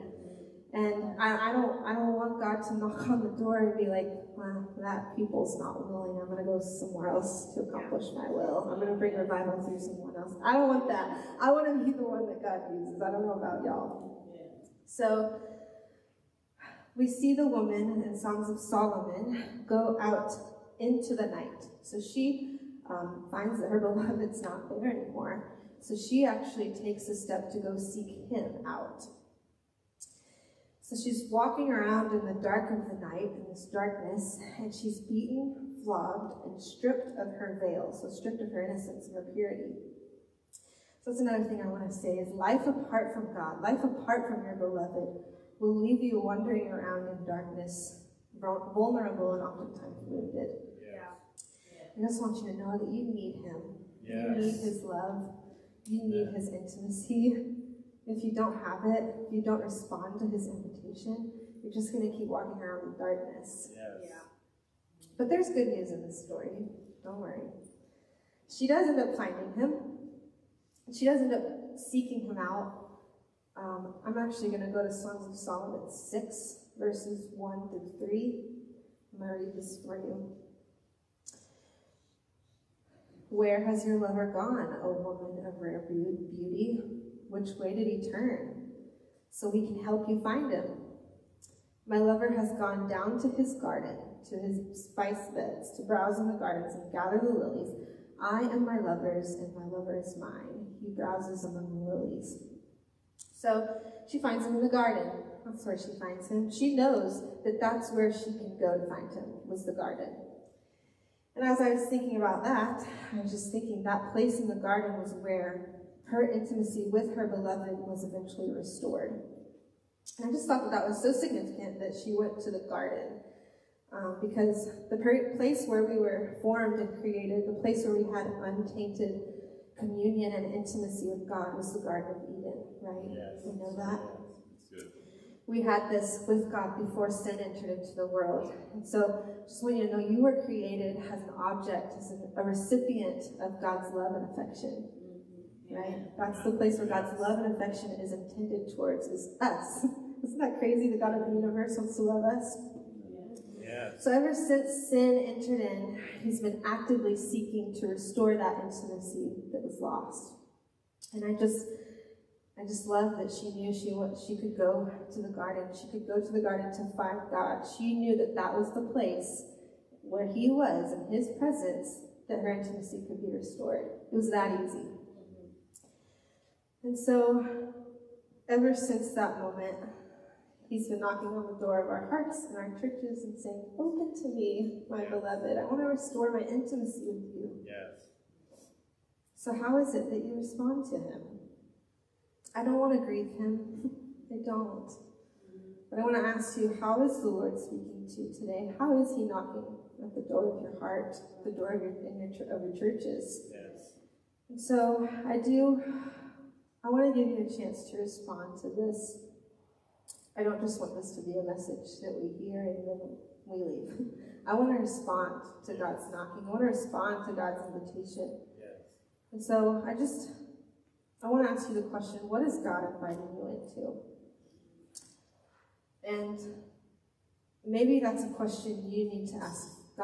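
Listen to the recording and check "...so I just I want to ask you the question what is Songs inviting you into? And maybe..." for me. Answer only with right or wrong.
wrong.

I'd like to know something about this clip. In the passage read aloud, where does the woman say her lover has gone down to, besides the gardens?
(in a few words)
His spice beds.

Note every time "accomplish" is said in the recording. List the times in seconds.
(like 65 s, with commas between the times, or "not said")
7 s.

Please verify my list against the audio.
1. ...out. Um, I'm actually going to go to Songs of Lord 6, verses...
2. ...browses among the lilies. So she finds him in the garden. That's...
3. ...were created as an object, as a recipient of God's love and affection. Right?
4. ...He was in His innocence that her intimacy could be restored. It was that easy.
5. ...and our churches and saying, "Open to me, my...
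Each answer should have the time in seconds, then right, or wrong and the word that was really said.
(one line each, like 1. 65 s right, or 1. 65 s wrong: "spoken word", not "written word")
1. 72 s wrong: "Solomon", not "Lord"
2. 100 s right
3. 140 s right
4. 170 s wrong: "presence", not "innocence"
5. 182 s right.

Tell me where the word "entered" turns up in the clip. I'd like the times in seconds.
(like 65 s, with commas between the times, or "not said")
137 s, 155 s.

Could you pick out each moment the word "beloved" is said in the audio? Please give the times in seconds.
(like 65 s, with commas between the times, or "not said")
23 s, 44 s, 117 s, 185 s.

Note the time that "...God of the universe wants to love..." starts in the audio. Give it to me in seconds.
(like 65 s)
150 s.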